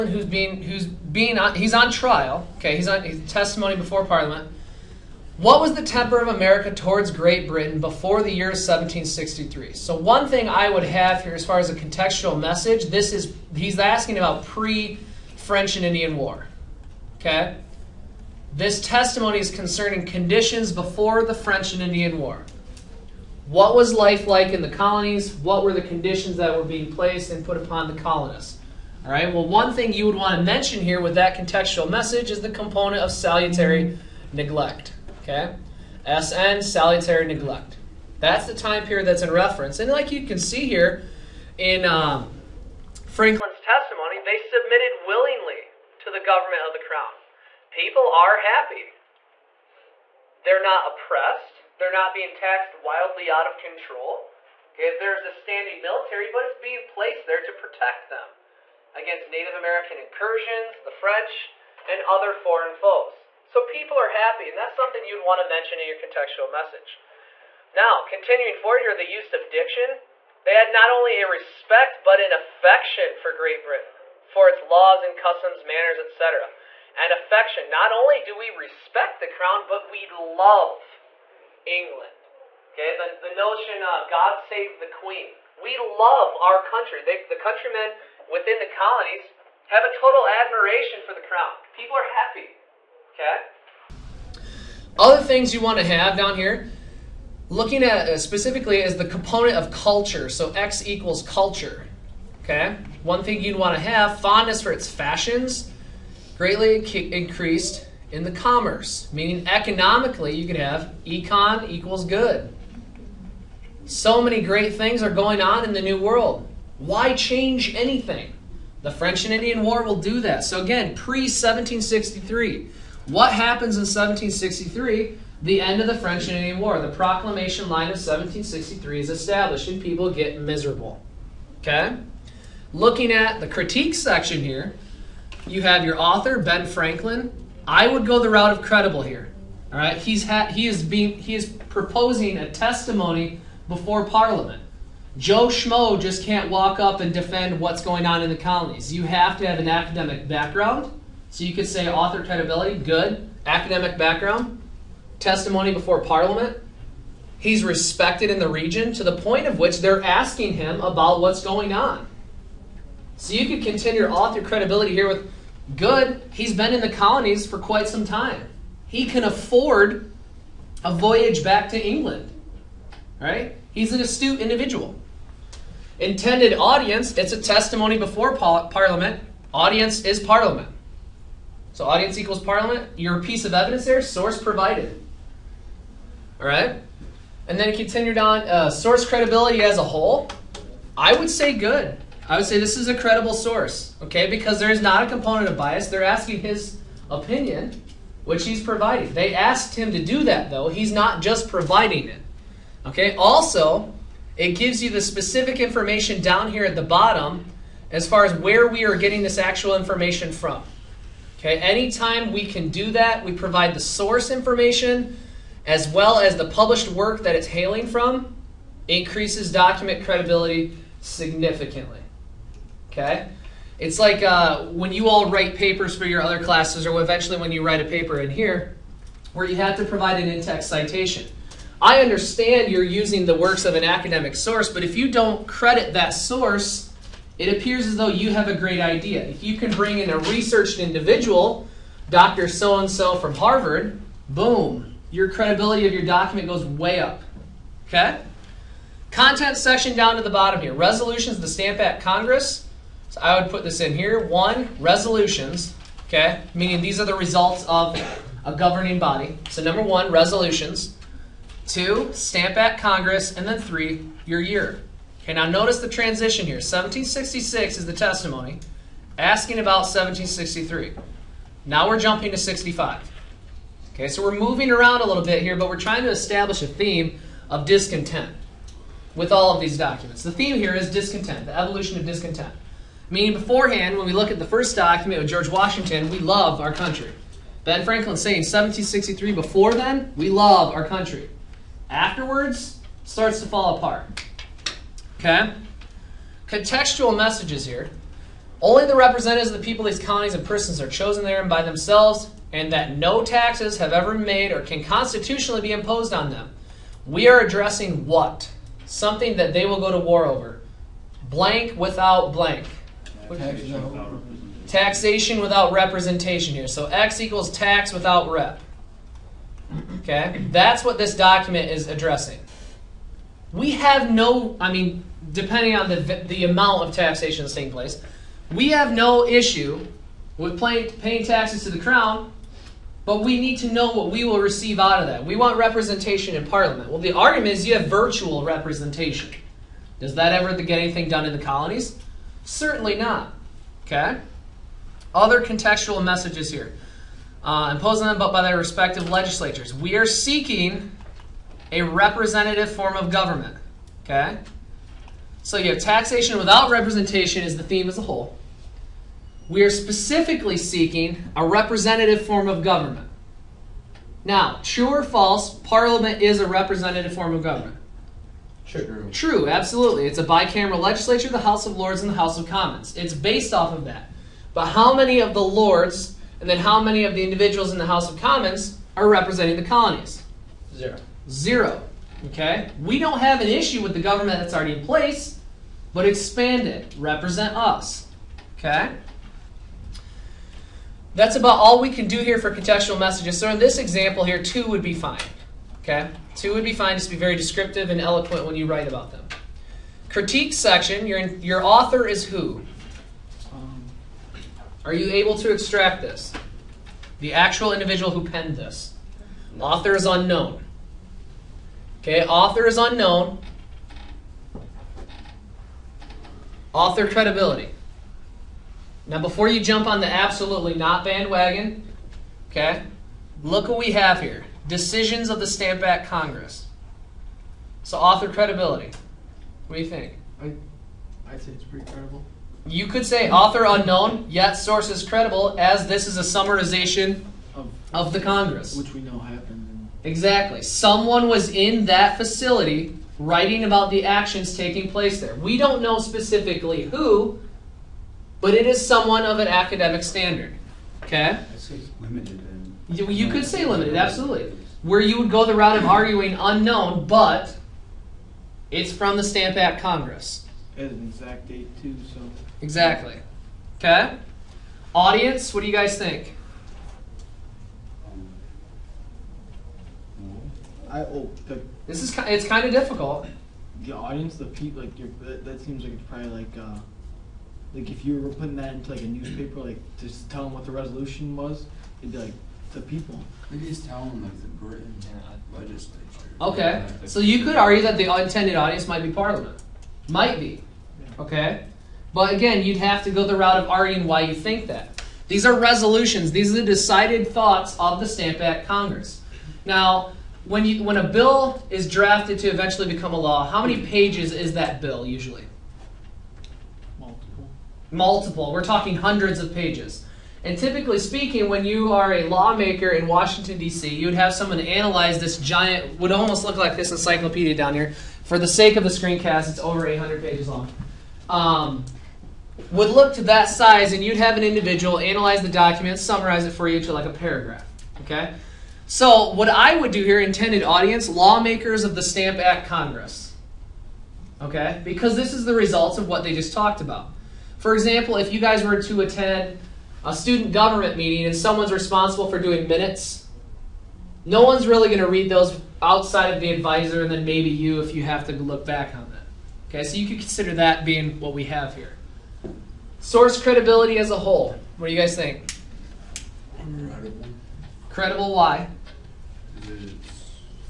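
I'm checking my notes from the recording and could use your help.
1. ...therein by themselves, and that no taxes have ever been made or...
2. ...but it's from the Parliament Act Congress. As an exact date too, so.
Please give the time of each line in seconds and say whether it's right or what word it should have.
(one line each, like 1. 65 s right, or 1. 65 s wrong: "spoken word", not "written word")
1. 301 s right
2. 457 s wrong: "Stamp", not "Parliament".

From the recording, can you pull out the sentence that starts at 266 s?
1766 is the testimony asking about 1763.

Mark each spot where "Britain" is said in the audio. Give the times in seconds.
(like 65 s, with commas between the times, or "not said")
7 s, 73 s, 484 s.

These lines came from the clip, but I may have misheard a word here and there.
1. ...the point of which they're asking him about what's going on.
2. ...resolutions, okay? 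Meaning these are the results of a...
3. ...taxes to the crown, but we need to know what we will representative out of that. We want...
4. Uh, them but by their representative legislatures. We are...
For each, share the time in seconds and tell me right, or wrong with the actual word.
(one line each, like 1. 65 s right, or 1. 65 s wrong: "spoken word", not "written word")
1. 159 s right
2. 254 s right
3. 331 s wrong: "receive", not "representative"
4. 347 s wrong: "respective", not "representative".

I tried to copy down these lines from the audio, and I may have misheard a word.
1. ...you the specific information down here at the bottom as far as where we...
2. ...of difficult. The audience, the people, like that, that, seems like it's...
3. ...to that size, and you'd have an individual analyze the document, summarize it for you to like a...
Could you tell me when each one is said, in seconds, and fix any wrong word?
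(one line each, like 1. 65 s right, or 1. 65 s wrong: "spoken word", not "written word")
1. 204 s right
2. 472 s right
3. 523 s right.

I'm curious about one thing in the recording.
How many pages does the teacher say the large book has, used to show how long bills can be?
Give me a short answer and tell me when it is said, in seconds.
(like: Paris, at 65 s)
Over 800, at 519 s.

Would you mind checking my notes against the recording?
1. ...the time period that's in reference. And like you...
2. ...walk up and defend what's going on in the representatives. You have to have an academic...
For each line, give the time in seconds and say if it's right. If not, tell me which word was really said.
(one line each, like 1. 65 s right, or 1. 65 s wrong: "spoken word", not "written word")
1. 38 s right
2. 146 s wrong: "colonies", not "representatives".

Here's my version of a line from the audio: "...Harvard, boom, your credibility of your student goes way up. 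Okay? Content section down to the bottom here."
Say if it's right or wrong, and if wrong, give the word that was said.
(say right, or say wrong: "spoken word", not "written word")
wrong: "document", not "student".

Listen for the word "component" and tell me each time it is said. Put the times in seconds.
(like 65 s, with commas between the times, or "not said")
32 s, 99 s, 195 s.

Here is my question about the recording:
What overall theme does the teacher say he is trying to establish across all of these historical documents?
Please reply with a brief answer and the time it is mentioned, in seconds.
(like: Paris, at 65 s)
Evolution of discontent, at 281 s.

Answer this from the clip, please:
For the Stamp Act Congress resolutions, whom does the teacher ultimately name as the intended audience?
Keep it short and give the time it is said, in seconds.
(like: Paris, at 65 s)
Lawmakers of the Stamp Act Congress, at 531 s.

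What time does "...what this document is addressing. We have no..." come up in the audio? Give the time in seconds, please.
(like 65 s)
320 s.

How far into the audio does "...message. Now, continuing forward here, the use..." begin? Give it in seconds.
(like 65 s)
66 s.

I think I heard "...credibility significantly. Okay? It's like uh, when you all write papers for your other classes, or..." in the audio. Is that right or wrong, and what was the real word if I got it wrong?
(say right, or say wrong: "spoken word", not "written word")
right.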